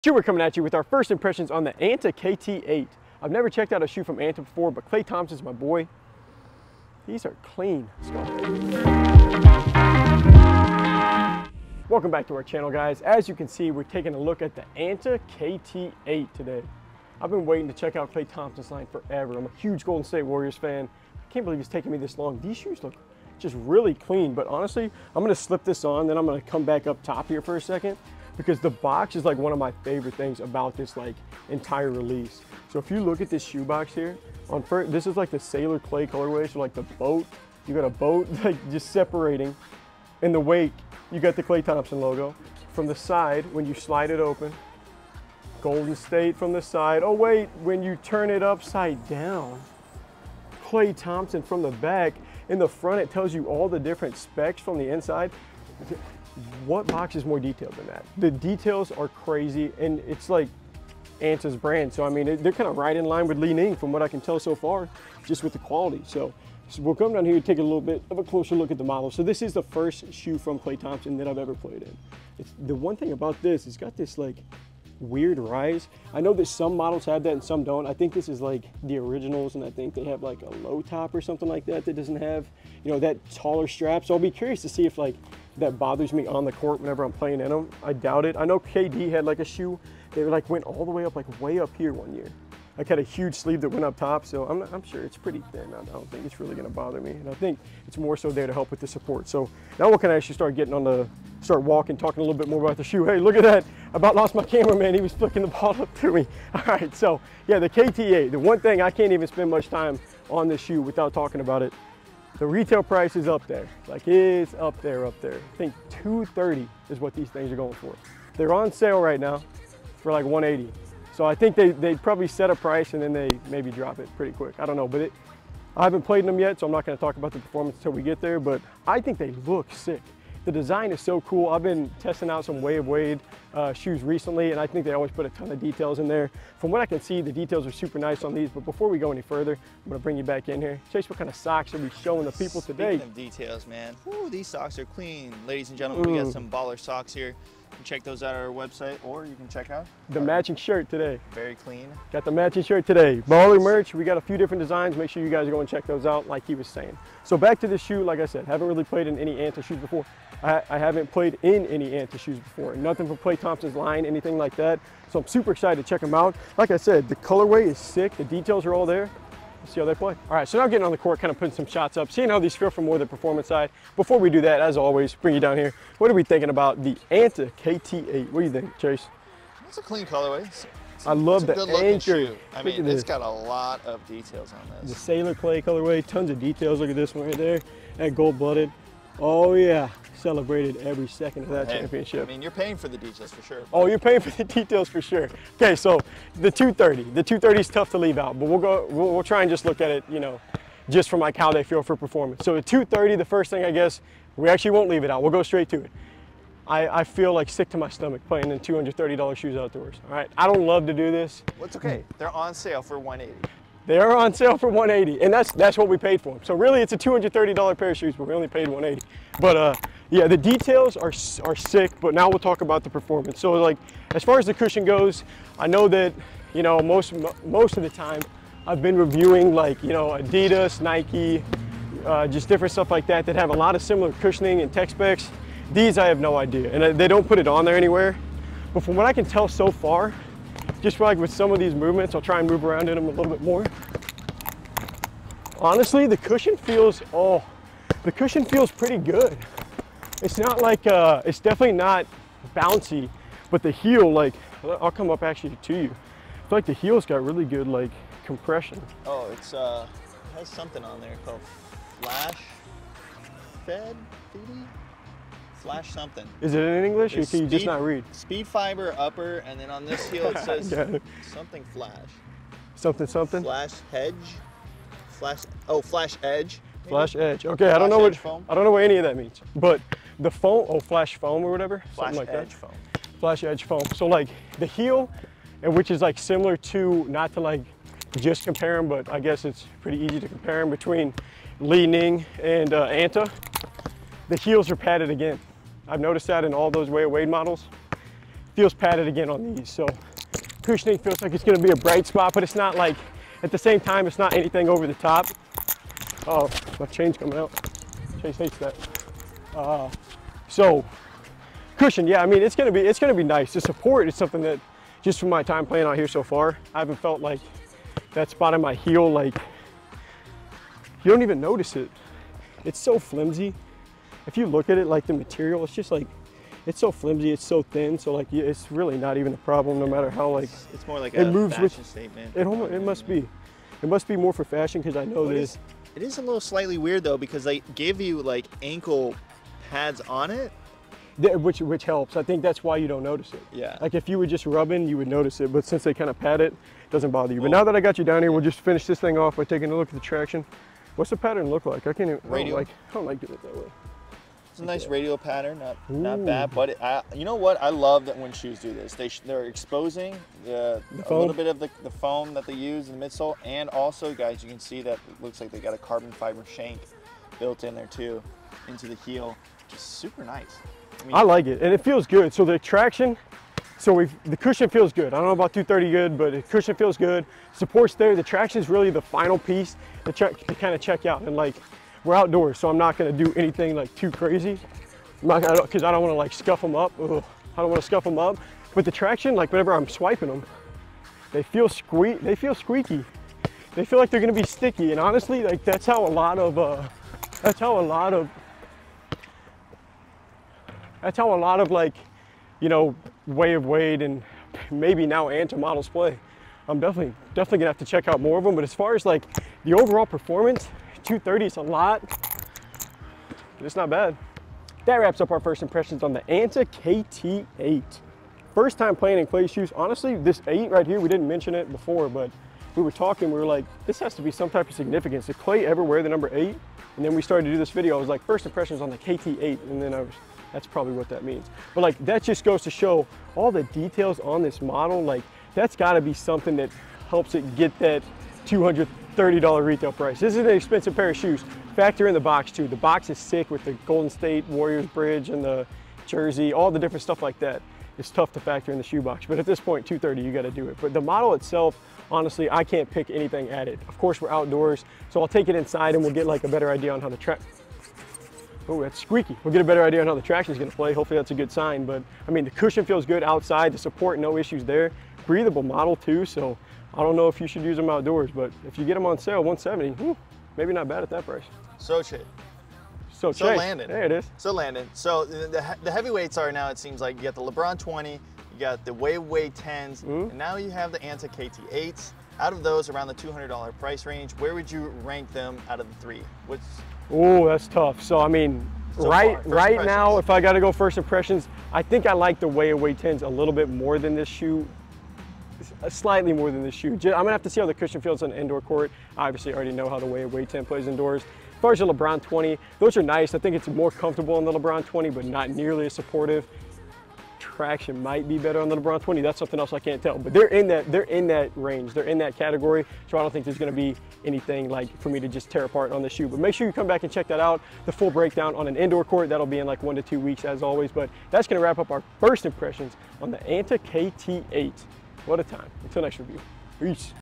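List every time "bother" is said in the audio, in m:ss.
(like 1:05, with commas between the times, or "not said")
1:25, 1:36, 5:47.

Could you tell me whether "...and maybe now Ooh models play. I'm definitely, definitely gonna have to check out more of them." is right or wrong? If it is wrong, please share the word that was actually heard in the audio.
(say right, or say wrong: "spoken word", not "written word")
wrong: "Anta", not "Ooh".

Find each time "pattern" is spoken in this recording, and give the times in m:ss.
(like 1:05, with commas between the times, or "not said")
5:51, 5:55.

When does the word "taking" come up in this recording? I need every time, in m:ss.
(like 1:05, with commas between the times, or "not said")
0:13, 0:21, 5:49.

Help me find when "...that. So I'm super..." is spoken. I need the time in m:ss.
2:44.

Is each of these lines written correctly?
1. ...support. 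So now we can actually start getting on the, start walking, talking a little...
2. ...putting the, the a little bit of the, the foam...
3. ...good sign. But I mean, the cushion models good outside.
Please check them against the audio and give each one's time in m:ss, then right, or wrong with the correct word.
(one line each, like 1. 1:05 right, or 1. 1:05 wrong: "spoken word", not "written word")
1. 1:38 right
2. 5:59 wrong: "exposing", not "putting"
3. 7:41 wrong: "feels", not "models".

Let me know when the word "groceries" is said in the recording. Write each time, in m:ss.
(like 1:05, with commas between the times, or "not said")
not said.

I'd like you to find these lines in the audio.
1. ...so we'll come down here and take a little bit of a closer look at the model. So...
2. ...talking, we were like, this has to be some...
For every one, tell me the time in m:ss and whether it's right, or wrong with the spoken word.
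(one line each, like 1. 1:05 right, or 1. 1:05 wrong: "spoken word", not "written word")
1. 1:06 right
2. 7:02 right.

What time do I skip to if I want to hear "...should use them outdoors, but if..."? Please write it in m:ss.
7:47.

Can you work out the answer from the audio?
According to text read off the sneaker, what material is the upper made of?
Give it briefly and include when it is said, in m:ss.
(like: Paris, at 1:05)
Speed fiber, at 4:28.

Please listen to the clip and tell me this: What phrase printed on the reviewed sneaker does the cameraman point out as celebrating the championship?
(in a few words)
gold-blooded.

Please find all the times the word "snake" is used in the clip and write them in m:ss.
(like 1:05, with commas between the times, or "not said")
not said.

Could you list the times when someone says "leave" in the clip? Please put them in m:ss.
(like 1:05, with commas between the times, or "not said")
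3:17, 3:24.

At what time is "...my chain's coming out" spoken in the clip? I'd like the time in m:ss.
5:06.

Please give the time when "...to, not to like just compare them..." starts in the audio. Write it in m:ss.
4:46.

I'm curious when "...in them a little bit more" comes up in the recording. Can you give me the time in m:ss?
4:02.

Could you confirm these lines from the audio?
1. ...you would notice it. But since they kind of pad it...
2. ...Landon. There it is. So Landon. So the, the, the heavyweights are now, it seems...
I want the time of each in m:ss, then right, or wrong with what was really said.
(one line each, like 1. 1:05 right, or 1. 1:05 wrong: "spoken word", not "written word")
1. 5:44 right
2. 7:53 right.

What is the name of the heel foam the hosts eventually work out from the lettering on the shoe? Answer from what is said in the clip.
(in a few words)
Flash edge foam.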